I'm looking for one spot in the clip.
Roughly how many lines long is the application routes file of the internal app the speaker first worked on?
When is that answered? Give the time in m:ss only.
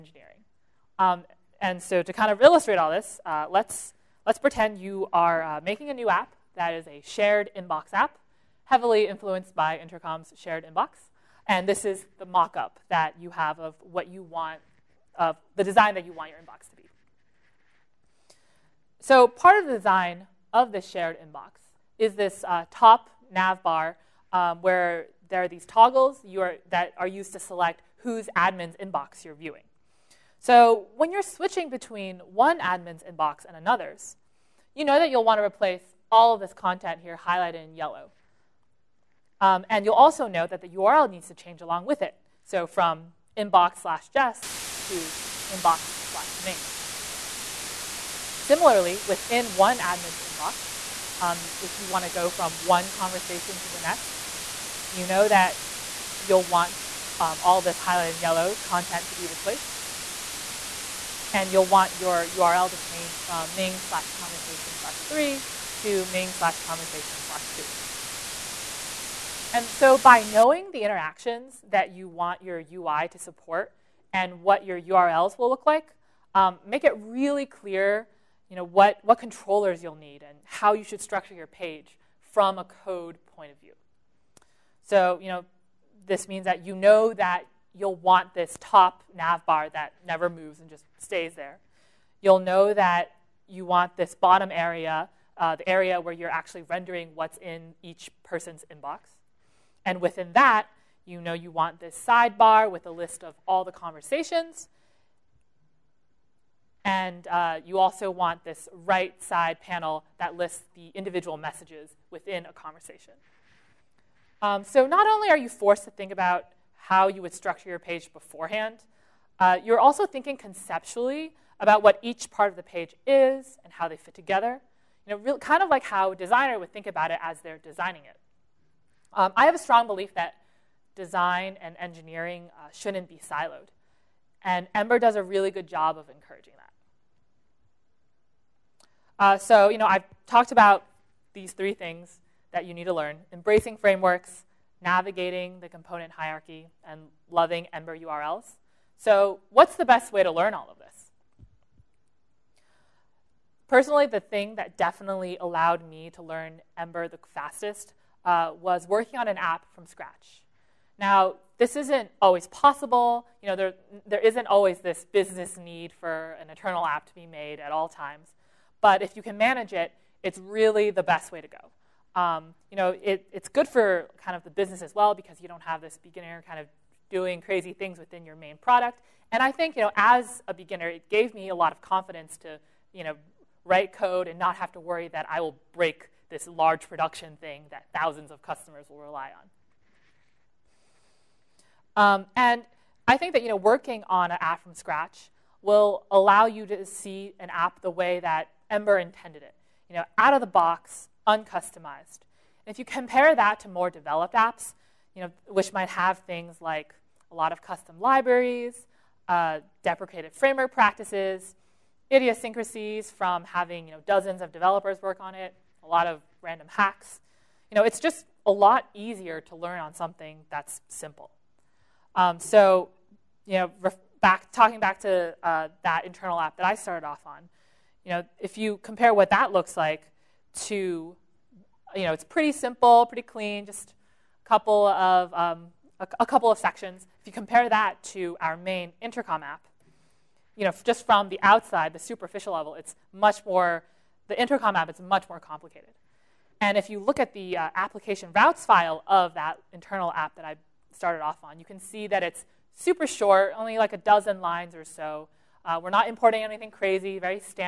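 4:13.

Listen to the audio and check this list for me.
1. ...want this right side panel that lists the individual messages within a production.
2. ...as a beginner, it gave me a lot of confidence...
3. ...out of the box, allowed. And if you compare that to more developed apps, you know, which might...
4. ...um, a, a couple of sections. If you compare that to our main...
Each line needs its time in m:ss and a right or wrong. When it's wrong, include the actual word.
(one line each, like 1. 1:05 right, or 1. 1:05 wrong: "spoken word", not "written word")
1. 1:48 wrong: "conversation", not "production"
2. 2:59 right
3. 3:20 wrong: "uncustomized", not "allowed"
4. 3:55 right.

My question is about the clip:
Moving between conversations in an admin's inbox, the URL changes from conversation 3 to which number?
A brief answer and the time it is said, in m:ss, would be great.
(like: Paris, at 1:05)
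2, at 1:06.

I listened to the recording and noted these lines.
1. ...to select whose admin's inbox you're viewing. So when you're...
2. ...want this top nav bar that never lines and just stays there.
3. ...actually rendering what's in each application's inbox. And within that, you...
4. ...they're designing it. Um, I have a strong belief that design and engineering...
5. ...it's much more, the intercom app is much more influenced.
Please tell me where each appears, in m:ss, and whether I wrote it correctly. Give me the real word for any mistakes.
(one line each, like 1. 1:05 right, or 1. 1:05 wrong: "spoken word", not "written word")
1. 0:27 right
2. 1:27 wrong: "moves", not "lines"
3. 1:36 wrong: "person", not "application"
4. 2:07 right
5. 4:02 wrong: "complicated", not "influenced".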